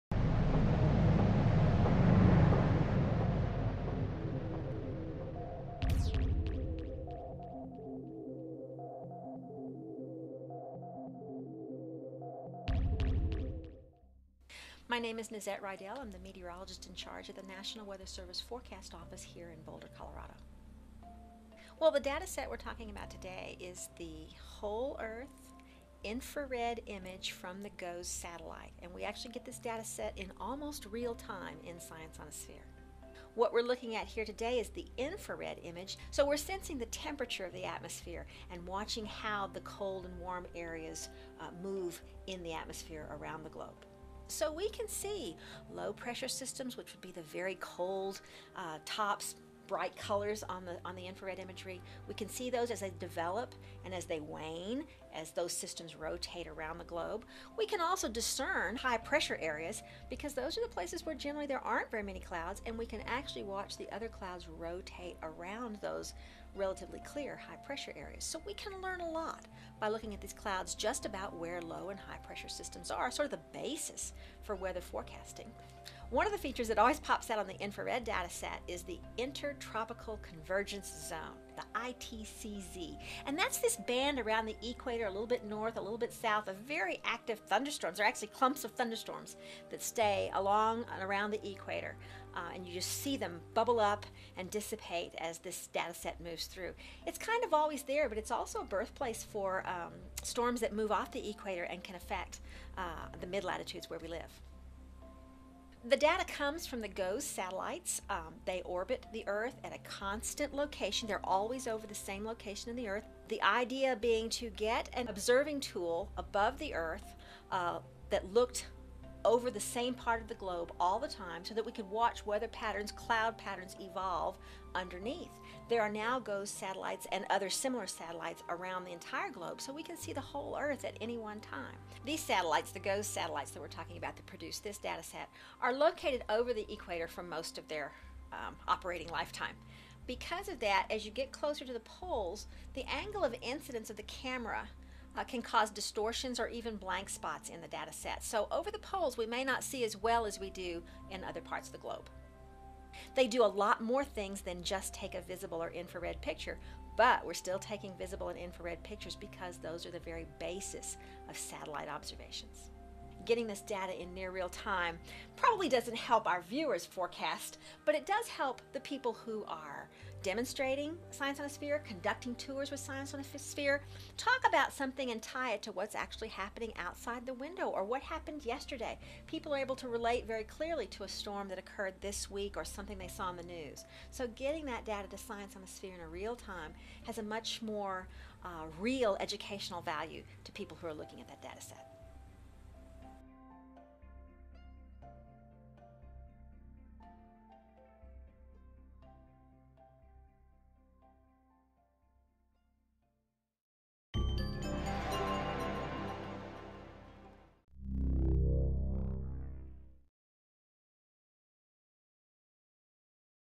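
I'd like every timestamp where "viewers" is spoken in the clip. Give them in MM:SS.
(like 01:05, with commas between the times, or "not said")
02:46.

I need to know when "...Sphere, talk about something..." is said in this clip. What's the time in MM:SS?
02:53.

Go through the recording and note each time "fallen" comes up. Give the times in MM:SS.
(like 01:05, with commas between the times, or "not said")
not said.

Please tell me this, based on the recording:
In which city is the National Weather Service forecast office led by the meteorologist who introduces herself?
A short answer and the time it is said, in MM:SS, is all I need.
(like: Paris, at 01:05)
Boulder, Colorado, at 00:19.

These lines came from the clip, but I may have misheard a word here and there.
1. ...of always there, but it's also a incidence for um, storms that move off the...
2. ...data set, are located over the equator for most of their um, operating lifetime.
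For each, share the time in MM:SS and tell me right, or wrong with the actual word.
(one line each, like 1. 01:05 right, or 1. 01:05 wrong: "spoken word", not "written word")
1. 01:37 wrong: "birthplace", not "incidence"
2. 02:14 right.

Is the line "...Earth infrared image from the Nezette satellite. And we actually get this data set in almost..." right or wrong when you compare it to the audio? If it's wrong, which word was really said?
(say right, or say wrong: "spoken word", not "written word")
wrong: "GOES", not "Nezette".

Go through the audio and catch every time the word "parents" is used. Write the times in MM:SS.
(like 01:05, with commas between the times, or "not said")
not said.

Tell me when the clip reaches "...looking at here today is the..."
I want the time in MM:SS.
00:33.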